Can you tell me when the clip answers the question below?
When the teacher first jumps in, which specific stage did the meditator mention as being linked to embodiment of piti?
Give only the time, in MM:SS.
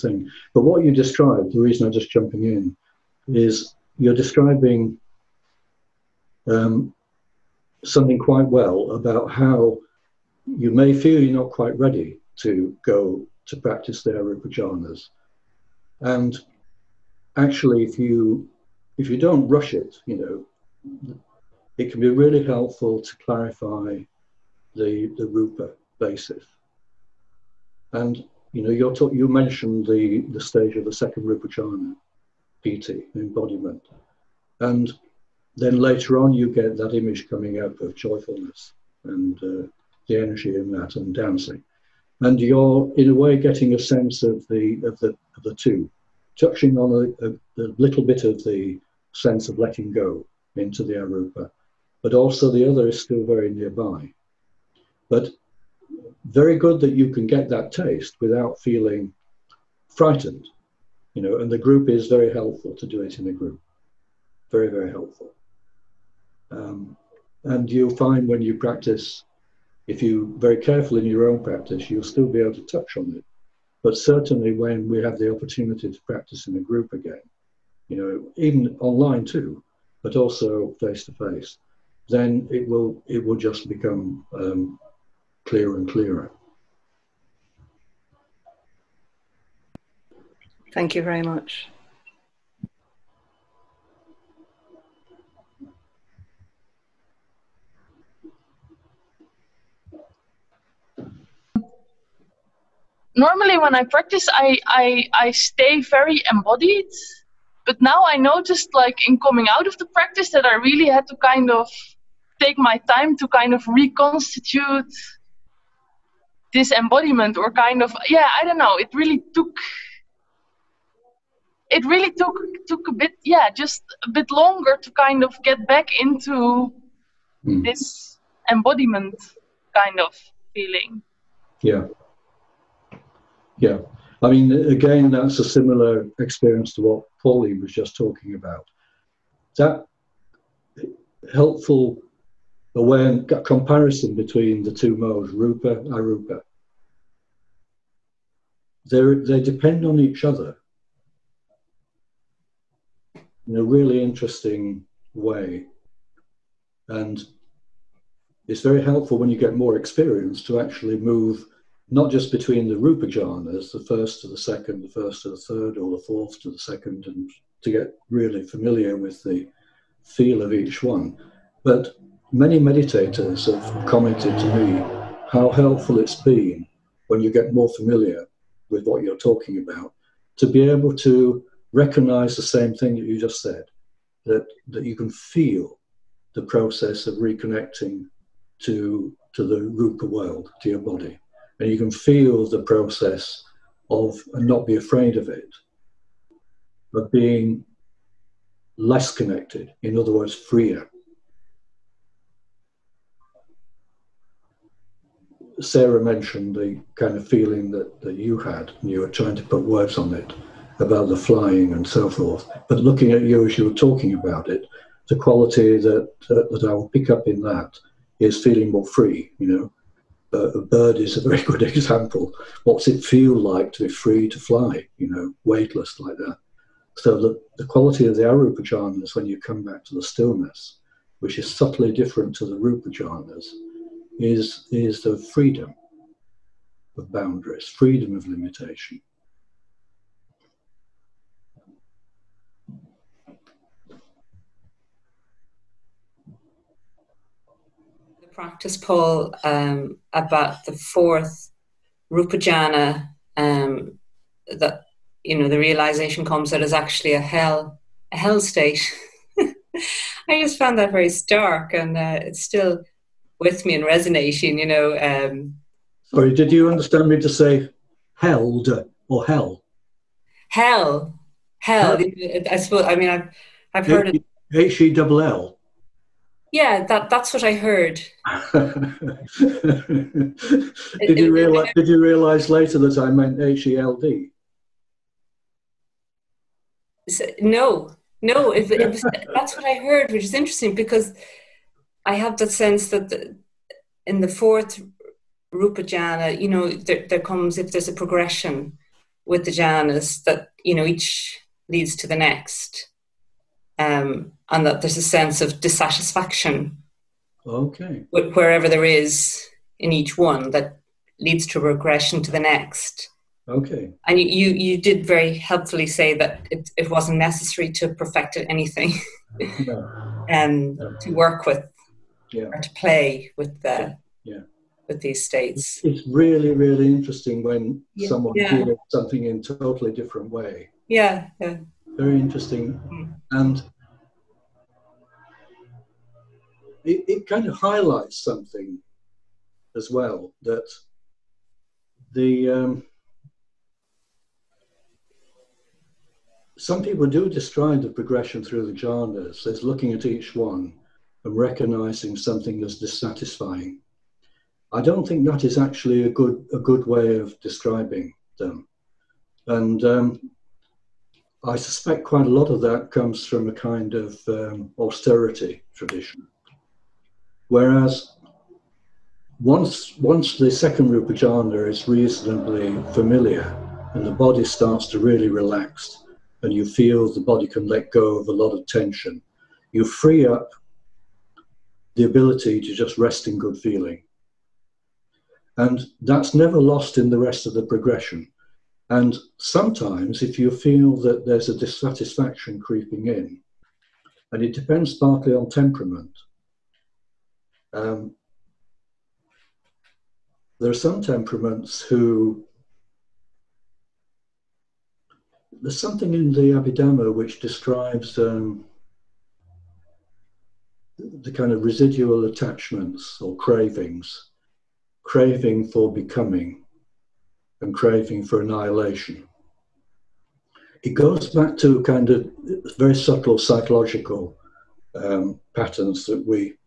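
00:30.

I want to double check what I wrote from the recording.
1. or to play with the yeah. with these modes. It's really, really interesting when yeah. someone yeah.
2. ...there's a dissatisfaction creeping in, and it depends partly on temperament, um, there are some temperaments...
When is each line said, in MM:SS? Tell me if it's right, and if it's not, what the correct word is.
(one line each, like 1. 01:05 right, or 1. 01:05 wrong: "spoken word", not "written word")
1. 05:22 wrong: "states", not "modes"
2. 06:31 right.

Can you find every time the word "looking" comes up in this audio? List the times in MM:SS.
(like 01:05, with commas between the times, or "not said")
03:32, 05:49.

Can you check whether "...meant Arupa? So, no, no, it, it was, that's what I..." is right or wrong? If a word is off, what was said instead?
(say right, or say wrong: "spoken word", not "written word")
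wrong: "HELD", not "Arupa".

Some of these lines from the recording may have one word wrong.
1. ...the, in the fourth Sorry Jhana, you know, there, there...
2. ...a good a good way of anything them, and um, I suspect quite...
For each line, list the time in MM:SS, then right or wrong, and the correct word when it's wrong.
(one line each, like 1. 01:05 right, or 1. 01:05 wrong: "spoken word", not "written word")
1. 04:53 wrong: "Rupa", not "Sorry"
2. 05:56 wrong: "describing", not "anything".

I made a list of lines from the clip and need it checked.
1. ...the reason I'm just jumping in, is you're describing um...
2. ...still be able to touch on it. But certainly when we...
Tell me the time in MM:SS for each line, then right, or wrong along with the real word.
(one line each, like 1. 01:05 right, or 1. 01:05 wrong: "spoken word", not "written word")
1. 00:01 right
2. 01:12 right.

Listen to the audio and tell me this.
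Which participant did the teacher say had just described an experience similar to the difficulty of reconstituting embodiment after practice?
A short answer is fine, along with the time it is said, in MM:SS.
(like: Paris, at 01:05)
Pauline, at 02:17.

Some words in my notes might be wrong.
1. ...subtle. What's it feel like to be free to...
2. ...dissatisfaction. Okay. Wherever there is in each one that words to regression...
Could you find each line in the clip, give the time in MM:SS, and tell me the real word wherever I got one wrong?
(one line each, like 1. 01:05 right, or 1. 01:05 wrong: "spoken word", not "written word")
1. 03:41 wrong: "example", not "subtle"
2. 05:05 wrong: "leads", not "words".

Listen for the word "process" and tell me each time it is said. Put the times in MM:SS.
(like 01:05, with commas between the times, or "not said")
03:06, 03:12.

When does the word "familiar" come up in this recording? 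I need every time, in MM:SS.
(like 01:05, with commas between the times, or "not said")
02:48, 02:57, 06:12.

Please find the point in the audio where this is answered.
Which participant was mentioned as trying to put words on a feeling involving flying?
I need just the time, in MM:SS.
03:25.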